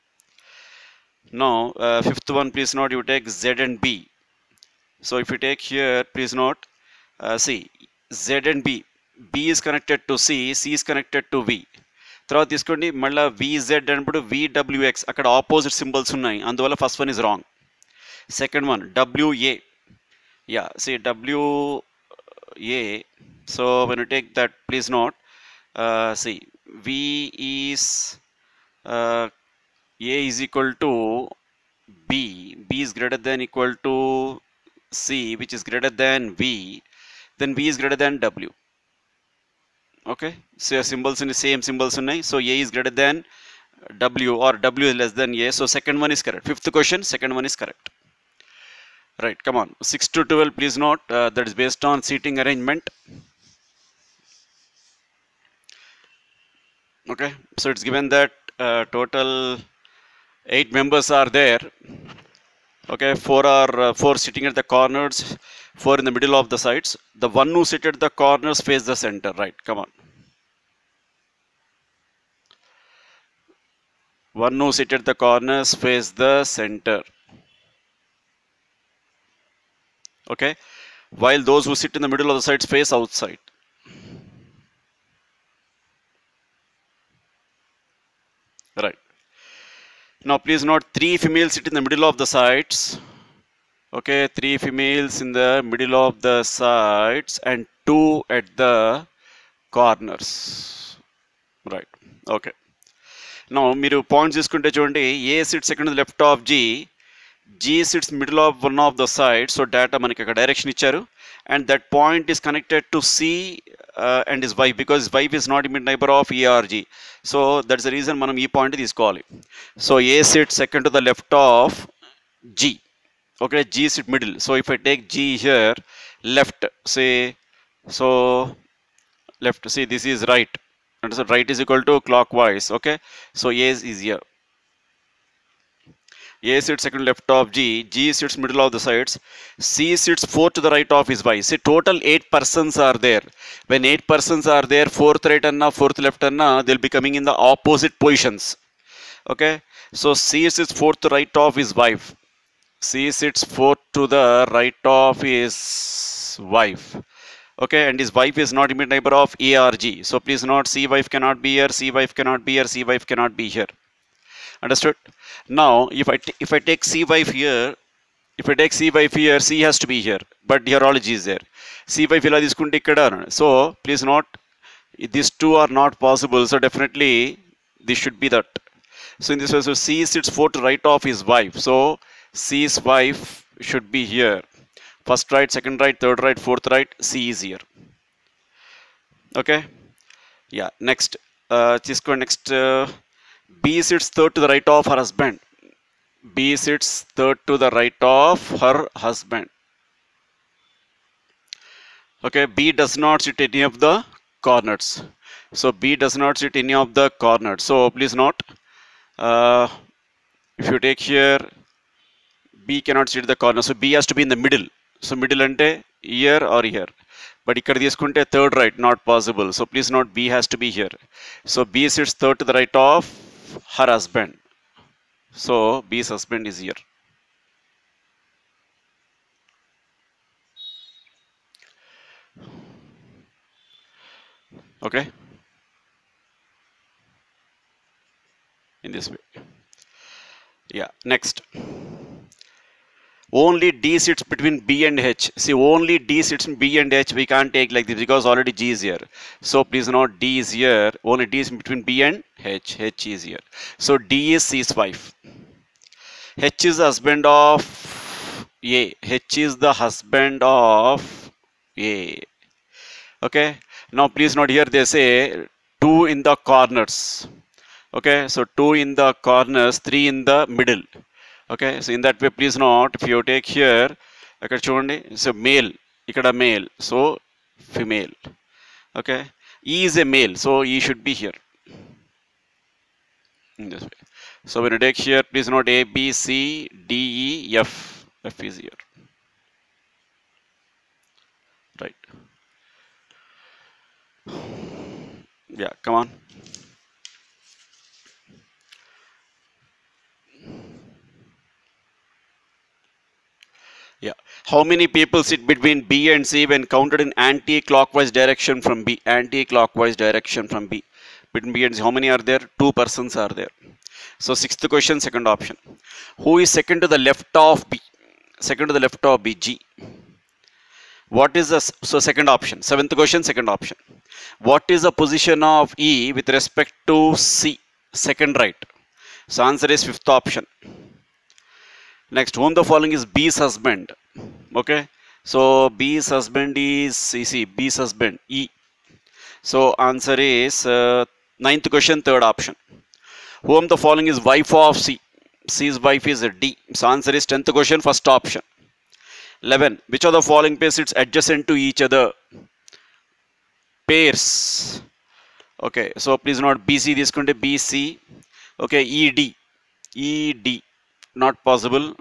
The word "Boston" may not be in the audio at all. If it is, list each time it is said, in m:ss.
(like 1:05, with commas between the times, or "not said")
not said.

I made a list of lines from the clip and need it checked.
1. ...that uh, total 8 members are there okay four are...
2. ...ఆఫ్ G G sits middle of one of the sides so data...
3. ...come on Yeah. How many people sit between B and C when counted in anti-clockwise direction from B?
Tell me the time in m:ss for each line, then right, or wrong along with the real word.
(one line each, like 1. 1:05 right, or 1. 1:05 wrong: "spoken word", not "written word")
1. 0:58 right
2. 1:46 right
3. 4:55 right.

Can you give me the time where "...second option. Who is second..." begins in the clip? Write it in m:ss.
5:14.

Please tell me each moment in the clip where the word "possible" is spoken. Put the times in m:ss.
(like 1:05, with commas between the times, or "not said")
2:56, 3:39, 6:01.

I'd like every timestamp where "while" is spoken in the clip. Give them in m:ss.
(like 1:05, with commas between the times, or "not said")
1:21.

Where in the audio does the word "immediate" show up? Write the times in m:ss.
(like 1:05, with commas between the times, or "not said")
2:38.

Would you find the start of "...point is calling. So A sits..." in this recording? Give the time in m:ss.
1:58.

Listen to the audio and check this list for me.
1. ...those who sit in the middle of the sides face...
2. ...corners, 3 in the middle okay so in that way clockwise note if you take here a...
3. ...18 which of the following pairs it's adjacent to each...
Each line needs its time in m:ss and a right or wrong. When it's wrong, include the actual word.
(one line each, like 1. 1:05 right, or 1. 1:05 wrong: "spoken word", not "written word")
1. 1:21 right
2. 4:29 wrong: "please", not "clockwise"
3. 5:49 wrong: "11", not "18".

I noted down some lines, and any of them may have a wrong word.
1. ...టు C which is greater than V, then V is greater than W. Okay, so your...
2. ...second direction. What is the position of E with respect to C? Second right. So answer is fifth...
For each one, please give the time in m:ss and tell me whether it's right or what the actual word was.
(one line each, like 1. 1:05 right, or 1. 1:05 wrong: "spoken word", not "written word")
1. 0:33 right
2. 5:23 wrong: "option", not "direction".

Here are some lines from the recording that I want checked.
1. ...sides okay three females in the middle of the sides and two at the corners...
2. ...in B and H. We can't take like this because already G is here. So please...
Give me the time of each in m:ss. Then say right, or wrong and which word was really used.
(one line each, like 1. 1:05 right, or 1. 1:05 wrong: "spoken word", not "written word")
1. 1:32 right
2. 4:06 right.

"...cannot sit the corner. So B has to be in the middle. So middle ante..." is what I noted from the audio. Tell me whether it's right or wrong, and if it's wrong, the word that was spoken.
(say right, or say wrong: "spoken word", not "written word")
right.